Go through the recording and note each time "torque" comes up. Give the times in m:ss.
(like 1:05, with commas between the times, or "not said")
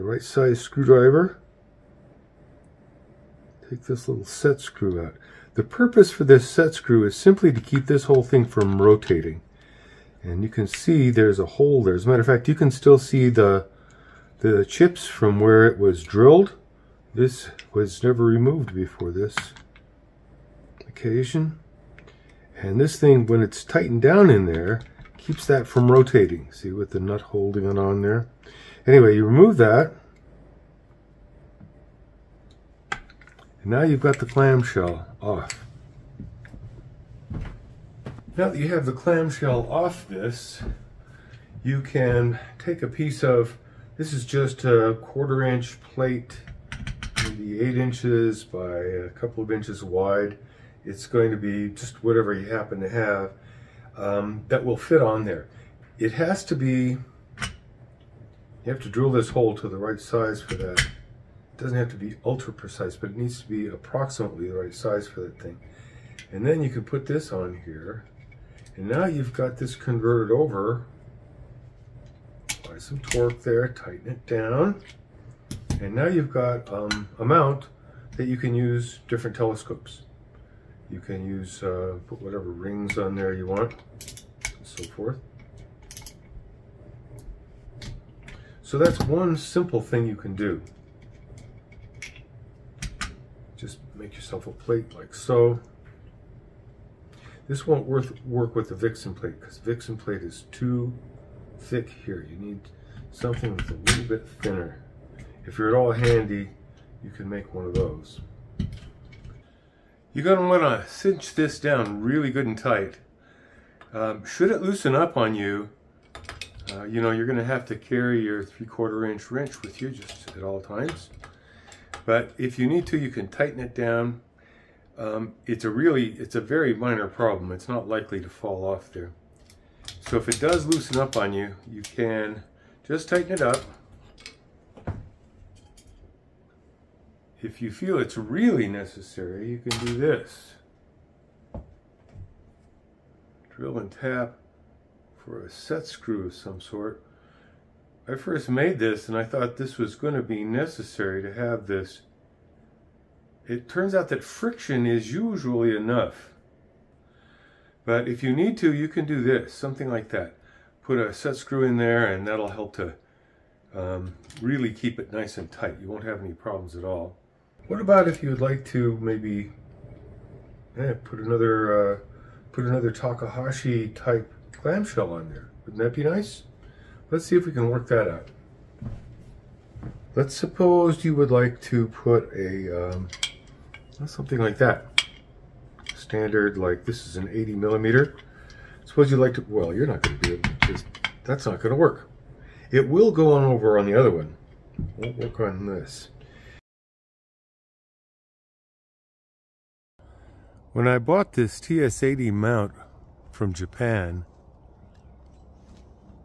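1:12.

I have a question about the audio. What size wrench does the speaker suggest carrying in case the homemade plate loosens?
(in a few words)
3/4 inch.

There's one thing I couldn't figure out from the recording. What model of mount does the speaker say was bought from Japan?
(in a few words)
TS-80.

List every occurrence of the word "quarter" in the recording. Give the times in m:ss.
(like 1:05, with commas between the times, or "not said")
0:45, 1:58.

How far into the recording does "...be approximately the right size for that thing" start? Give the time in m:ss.
1:03.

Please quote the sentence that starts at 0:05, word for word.
The purpose for this set screw is simply to keep this whole thing from rotating.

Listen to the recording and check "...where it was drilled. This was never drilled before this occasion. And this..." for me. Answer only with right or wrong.
wrong.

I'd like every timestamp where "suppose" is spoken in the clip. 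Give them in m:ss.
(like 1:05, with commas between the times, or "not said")
3:00, 3:08.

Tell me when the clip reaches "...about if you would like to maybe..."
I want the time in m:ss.
2:47.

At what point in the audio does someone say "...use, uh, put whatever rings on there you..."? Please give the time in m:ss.
1:21.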